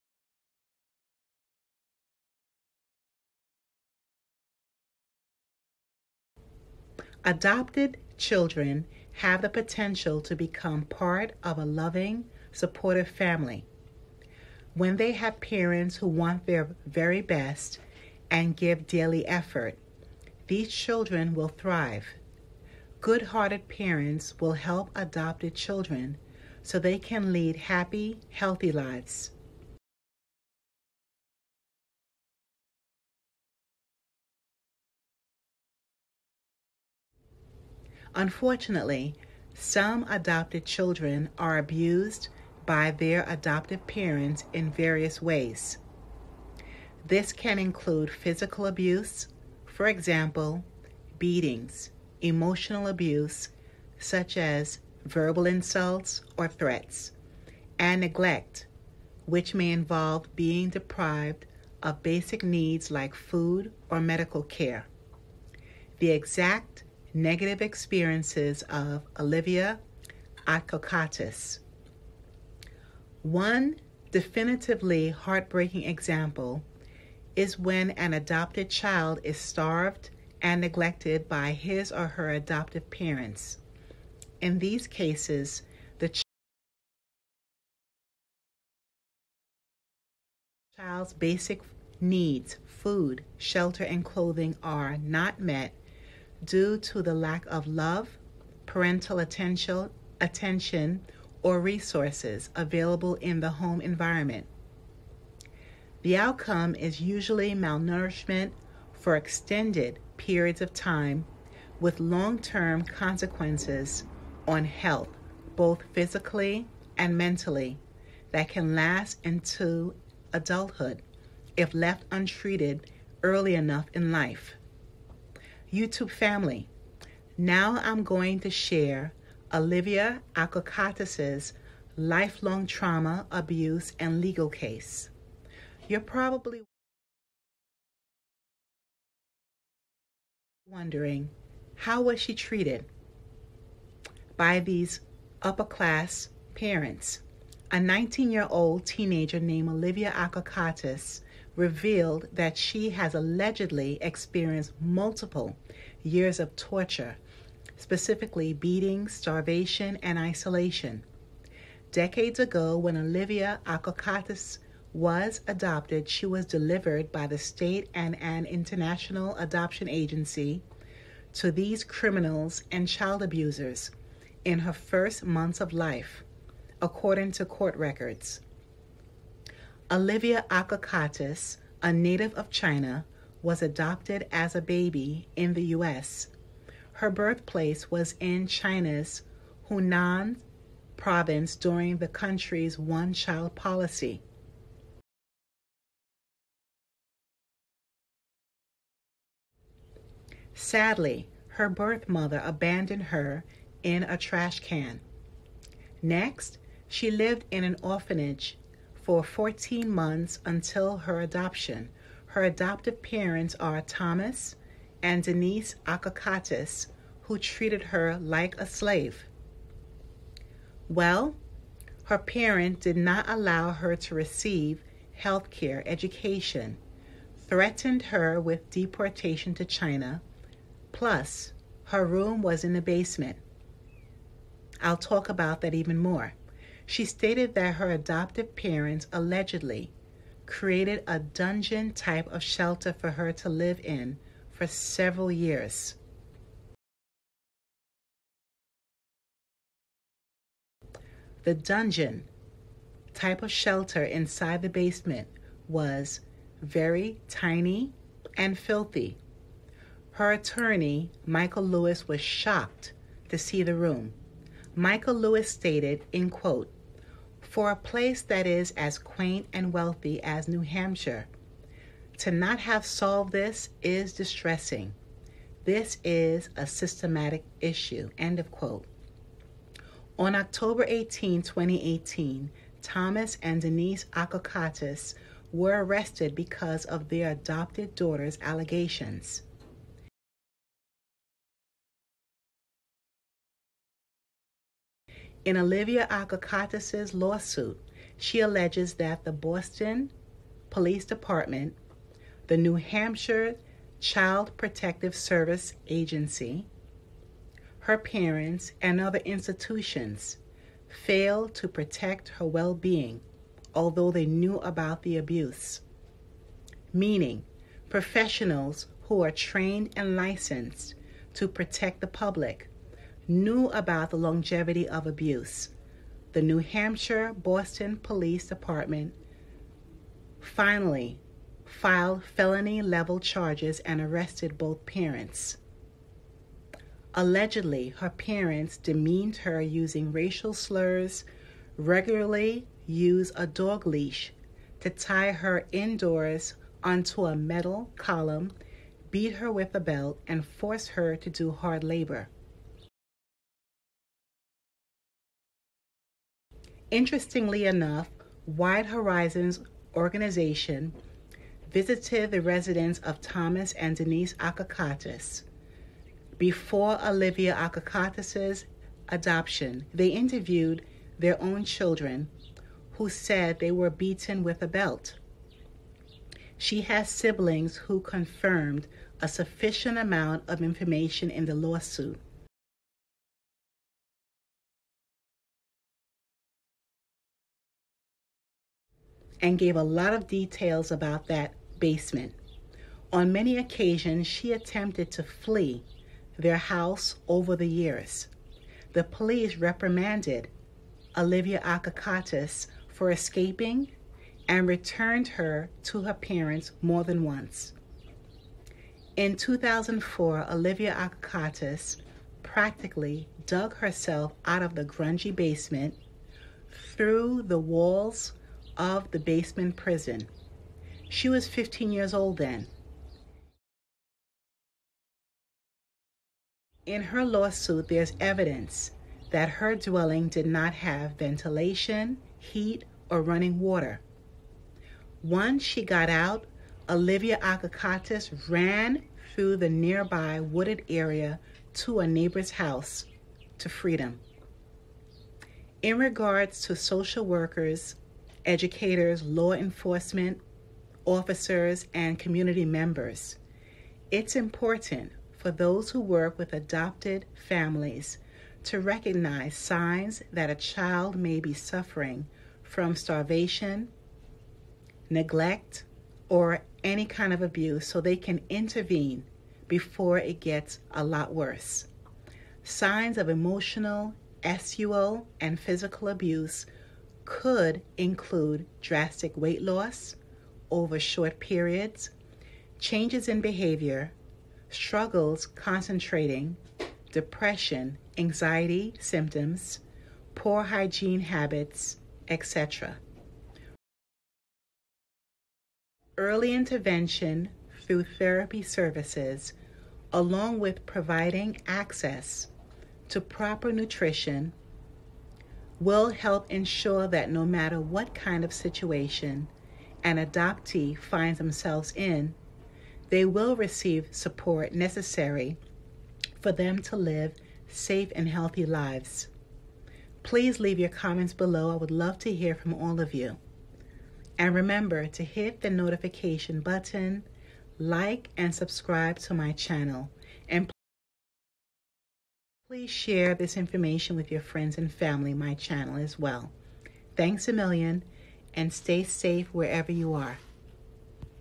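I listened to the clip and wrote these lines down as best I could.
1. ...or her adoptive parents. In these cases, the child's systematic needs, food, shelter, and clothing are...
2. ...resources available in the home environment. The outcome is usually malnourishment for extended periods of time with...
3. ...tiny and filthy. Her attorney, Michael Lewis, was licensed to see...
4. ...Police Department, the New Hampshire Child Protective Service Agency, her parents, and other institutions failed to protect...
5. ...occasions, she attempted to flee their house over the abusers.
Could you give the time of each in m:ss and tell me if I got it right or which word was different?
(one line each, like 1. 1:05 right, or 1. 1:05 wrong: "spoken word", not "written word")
1. 1:21 wrong: "basic", not "systematic"
2. 1:41 right
3. 4:17 wrong: "shocked", not "licensed"
4. 5:00 right
5. 6:33 wrong: "years", not "abusers".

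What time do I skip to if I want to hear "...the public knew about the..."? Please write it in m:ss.
5:21.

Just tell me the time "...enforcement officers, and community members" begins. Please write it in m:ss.
7:29.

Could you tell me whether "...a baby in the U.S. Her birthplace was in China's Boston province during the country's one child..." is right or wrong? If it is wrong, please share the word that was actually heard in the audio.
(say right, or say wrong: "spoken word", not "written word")
wrong: "Hunan", not "Boston".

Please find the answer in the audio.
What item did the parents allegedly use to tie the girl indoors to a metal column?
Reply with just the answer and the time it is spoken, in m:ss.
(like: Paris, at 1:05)
A dog leash, at 5:43.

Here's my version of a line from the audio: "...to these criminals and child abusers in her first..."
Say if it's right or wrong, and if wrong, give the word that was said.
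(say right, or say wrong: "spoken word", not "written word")
right.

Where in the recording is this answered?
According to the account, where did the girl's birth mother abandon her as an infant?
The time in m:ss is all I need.
3:24.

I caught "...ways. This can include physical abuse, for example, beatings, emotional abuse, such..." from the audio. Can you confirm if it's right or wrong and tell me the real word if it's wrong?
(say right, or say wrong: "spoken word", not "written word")
right.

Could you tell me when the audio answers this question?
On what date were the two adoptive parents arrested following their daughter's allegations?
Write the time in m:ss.
4:40.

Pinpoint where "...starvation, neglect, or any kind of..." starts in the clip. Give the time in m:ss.
7:42.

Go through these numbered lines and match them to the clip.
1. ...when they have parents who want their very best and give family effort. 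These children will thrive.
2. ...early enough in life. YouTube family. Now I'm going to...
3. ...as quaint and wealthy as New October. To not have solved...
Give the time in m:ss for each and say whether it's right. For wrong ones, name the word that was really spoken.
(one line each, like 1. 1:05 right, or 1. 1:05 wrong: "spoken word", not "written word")
1. 0:14 wrong: "daily", not "family"
2. 2:03 right
3. 4:28 wrong: "Hampshire", not "October".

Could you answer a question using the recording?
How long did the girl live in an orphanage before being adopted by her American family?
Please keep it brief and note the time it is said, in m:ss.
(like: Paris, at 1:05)
14 months, at 3:29.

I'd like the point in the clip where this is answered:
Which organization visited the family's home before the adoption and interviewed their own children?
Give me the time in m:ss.
5:58.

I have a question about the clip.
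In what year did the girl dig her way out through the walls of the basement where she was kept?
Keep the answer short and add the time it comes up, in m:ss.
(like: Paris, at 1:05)
2004, at 6:49.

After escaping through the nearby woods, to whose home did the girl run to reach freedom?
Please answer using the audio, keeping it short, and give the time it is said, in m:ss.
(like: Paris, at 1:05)
A neighbor's house, at 7:22.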